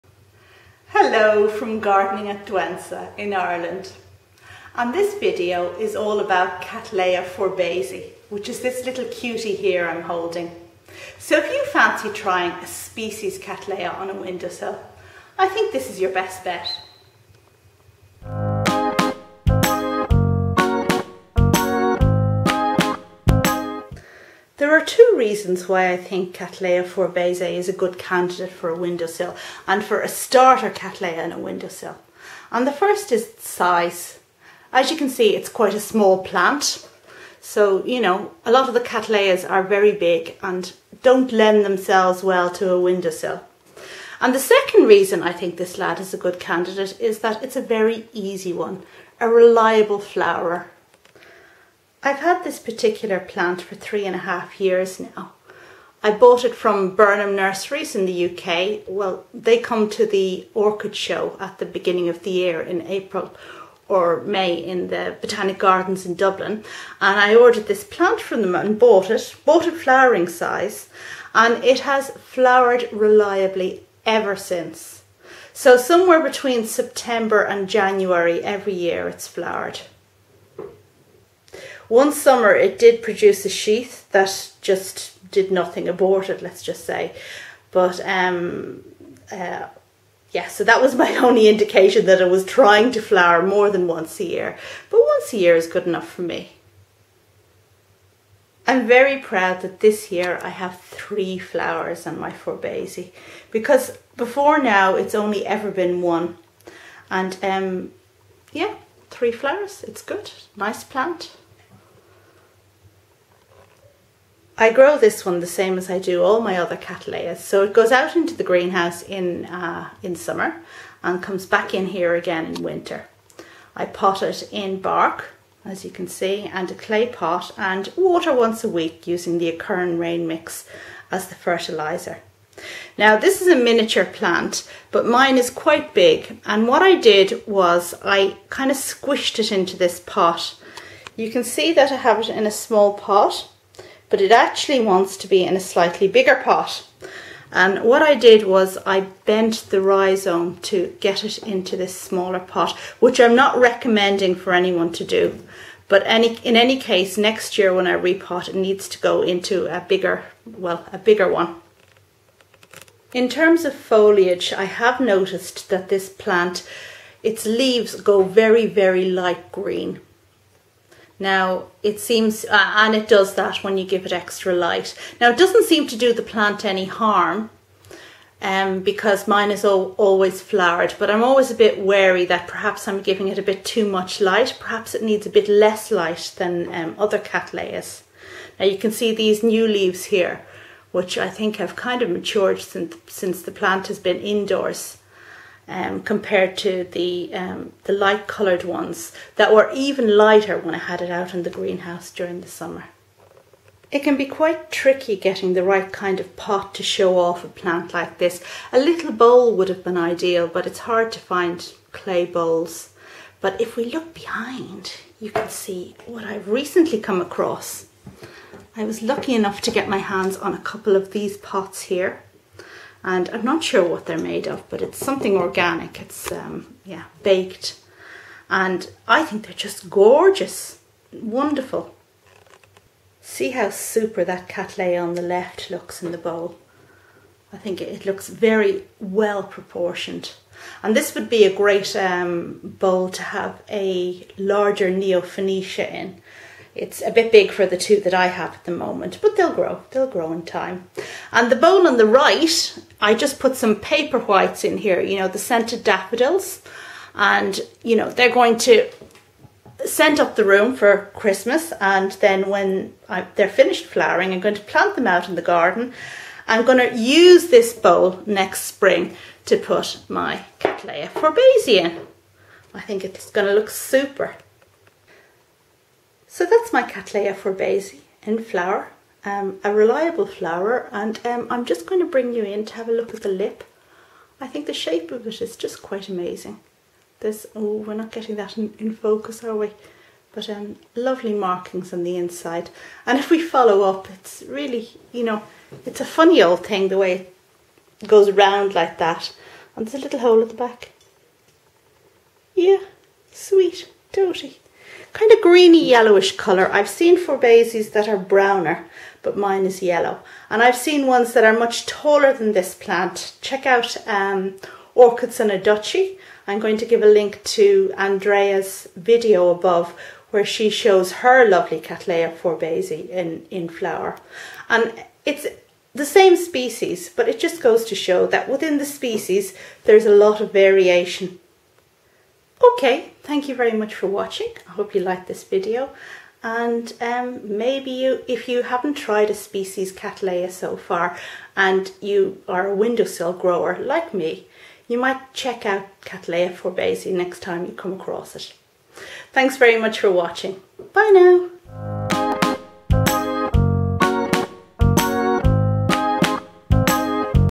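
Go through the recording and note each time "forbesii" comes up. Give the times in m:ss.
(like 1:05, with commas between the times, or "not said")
0:07, 0:26, 1:42, 4:31, 4:37, 5:07, 5:22, 5:46.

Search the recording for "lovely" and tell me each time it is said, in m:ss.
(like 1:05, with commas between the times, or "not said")
4:50, 5:21.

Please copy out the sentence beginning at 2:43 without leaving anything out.
In terms of foliage, I have noticed that this plant, its leaves go very, very light green.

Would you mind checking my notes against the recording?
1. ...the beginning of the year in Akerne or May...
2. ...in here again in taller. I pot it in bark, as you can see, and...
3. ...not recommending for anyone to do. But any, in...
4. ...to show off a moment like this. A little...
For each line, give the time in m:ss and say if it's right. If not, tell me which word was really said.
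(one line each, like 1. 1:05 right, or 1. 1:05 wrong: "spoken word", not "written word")
1. 1:01 wrong: "April", not "Akerne"
2. 2:01 wrong: "winter", not "taller"
3. 2:33 right
4. 3:26 wrong: "plant", not "moment".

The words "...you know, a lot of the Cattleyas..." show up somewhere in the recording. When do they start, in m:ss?
0:37.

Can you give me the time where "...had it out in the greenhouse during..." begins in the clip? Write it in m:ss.
3:20.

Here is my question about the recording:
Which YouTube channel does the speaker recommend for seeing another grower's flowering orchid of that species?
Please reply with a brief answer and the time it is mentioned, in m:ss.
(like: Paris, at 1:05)
Orchids and a Duchy, at 5:14.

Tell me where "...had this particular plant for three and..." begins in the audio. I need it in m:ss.
0:52.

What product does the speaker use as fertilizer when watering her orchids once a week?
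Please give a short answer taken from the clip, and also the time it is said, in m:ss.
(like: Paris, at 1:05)
Akerne Rain Mix, at 2:09.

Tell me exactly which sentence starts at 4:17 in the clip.
And, you know, they're going to scent up the room for Christmas.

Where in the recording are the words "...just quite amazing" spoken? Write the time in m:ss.
4:45.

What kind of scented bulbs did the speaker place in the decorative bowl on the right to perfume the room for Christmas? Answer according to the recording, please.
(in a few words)
paper whites.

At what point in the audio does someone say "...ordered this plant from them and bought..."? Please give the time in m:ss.
1:07.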